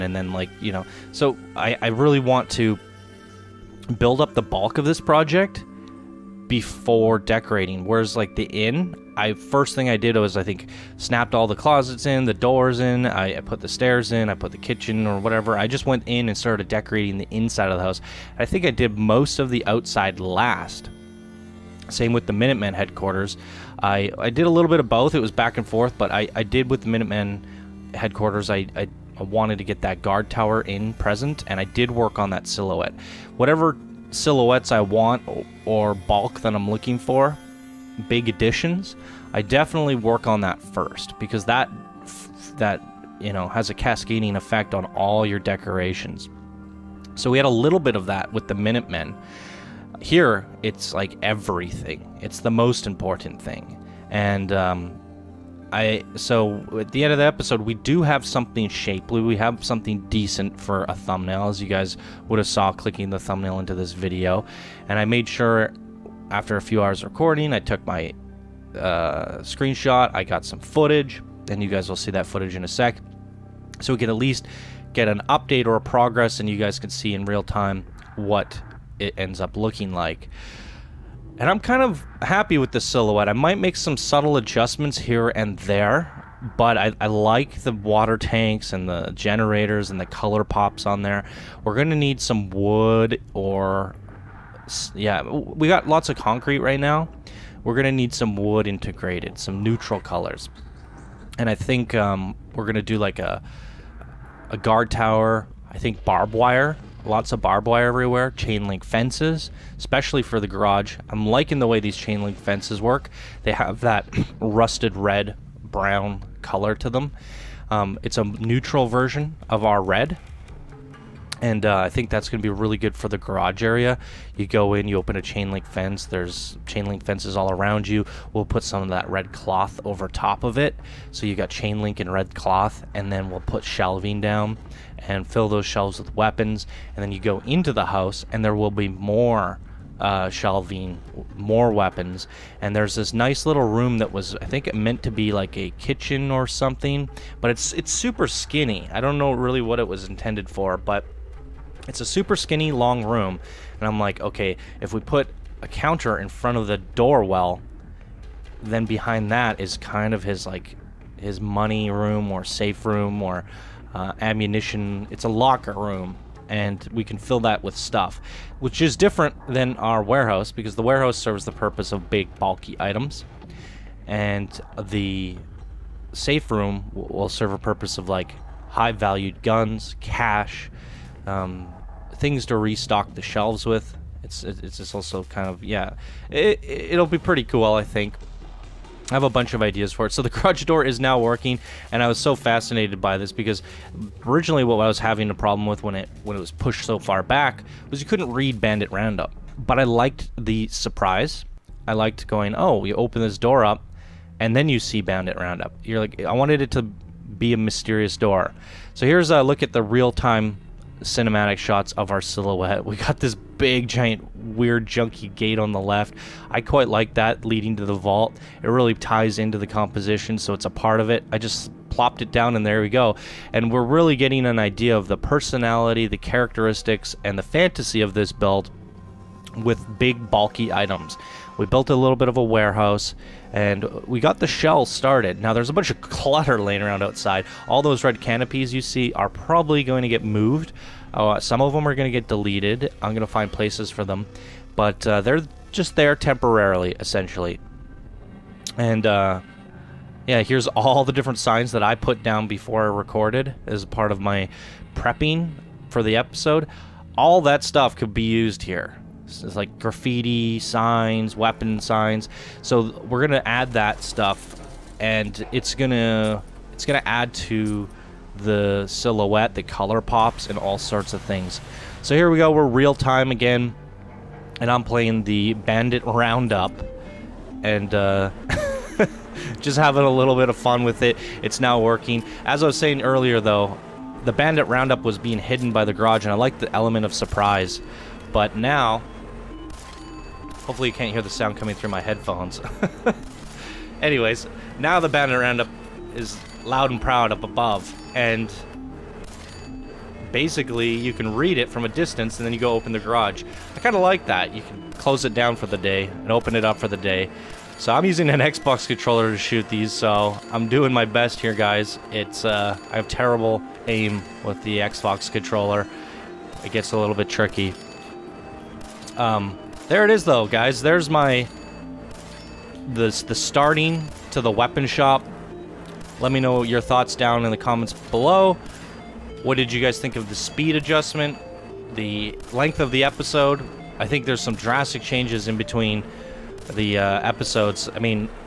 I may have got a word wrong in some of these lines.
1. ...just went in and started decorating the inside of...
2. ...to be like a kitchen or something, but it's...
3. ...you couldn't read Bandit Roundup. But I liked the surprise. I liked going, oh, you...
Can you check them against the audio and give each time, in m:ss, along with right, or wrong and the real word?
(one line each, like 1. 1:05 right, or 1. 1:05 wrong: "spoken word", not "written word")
1. 0:15 right
2. 2:25 right
3. 3:18 right.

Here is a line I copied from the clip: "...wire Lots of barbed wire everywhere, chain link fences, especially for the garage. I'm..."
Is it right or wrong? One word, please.
right.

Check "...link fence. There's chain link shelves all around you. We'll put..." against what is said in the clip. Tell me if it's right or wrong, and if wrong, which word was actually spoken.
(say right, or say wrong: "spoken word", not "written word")
wrong: "fences", not "shelves".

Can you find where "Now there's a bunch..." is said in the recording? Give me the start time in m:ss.
3:55.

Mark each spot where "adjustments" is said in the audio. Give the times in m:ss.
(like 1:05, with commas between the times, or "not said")
1:24, 5:30.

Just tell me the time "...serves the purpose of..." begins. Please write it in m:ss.
2:51.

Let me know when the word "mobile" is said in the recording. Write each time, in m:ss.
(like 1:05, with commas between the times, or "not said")
not said.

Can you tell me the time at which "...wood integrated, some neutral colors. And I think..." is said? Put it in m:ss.
1:38.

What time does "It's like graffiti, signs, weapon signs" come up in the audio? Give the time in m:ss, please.
4:19.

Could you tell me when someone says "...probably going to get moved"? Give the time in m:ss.
3:59.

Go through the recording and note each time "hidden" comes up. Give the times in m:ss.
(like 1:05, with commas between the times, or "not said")
4:45.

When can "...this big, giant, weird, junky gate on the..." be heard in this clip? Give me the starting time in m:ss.
3:33.